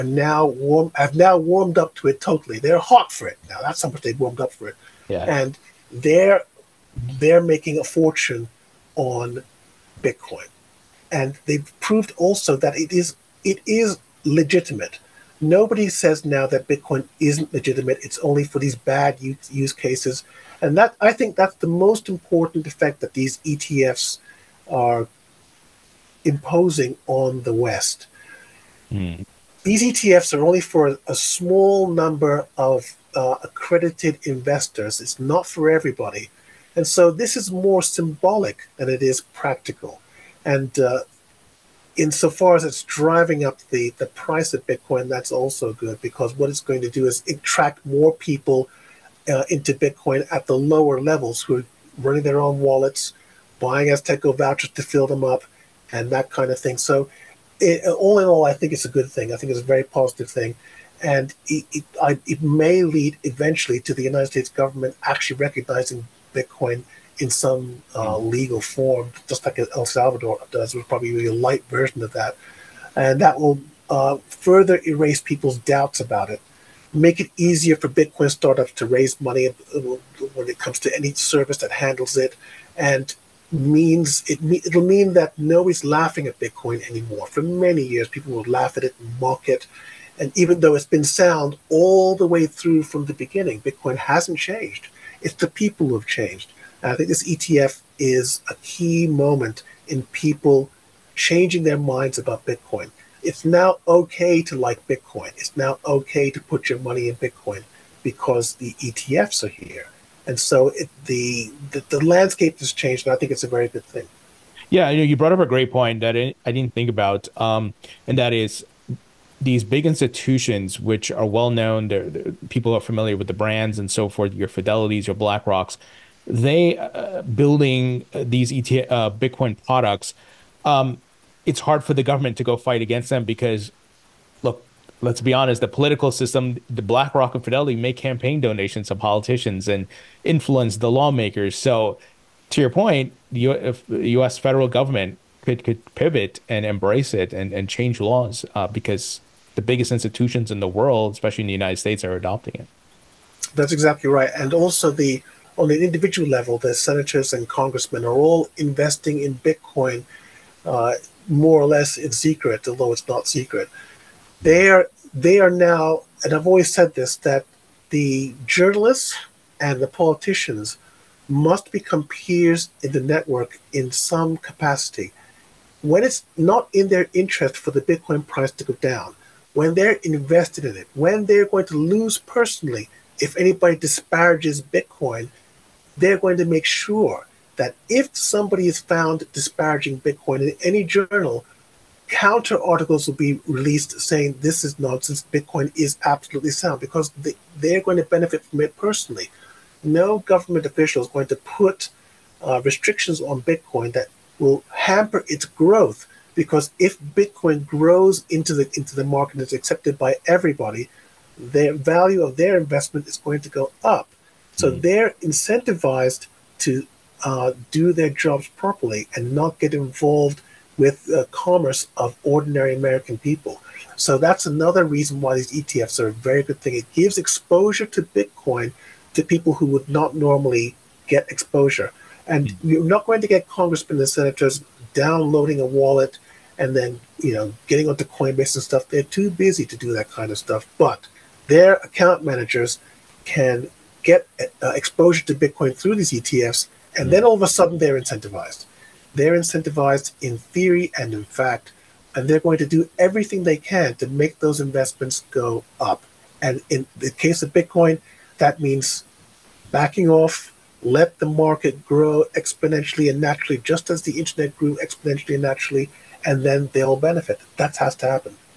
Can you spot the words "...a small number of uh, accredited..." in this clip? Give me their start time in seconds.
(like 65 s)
31 s.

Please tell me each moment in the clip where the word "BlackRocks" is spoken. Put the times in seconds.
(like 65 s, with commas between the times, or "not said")
125 s, 136 s.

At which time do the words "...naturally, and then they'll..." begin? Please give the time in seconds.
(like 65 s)
265 s.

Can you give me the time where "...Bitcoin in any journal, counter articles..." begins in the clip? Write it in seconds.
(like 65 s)
190 s.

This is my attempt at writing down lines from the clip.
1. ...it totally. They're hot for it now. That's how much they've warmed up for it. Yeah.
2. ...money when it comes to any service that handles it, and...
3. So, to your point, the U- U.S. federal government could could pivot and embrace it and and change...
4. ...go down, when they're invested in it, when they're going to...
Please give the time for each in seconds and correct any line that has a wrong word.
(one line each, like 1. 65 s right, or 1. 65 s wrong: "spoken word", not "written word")
1. 2 s right
2. 79 s right
3. 141 s right
4. 178 s right.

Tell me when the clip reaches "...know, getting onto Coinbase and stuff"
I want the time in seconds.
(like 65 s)
237 s.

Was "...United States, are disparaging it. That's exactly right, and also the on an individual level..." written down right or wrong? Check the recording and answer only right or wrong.
wrong.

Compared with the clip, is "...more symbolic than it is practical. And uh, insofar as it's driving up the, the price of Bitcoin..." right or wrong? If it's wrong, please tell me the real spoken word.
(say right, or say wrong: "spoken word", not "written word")
right.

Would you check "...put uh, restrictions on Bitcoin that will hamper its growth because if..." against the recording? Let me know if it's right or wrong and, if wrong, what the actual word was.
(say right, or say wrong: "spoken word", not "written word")
right.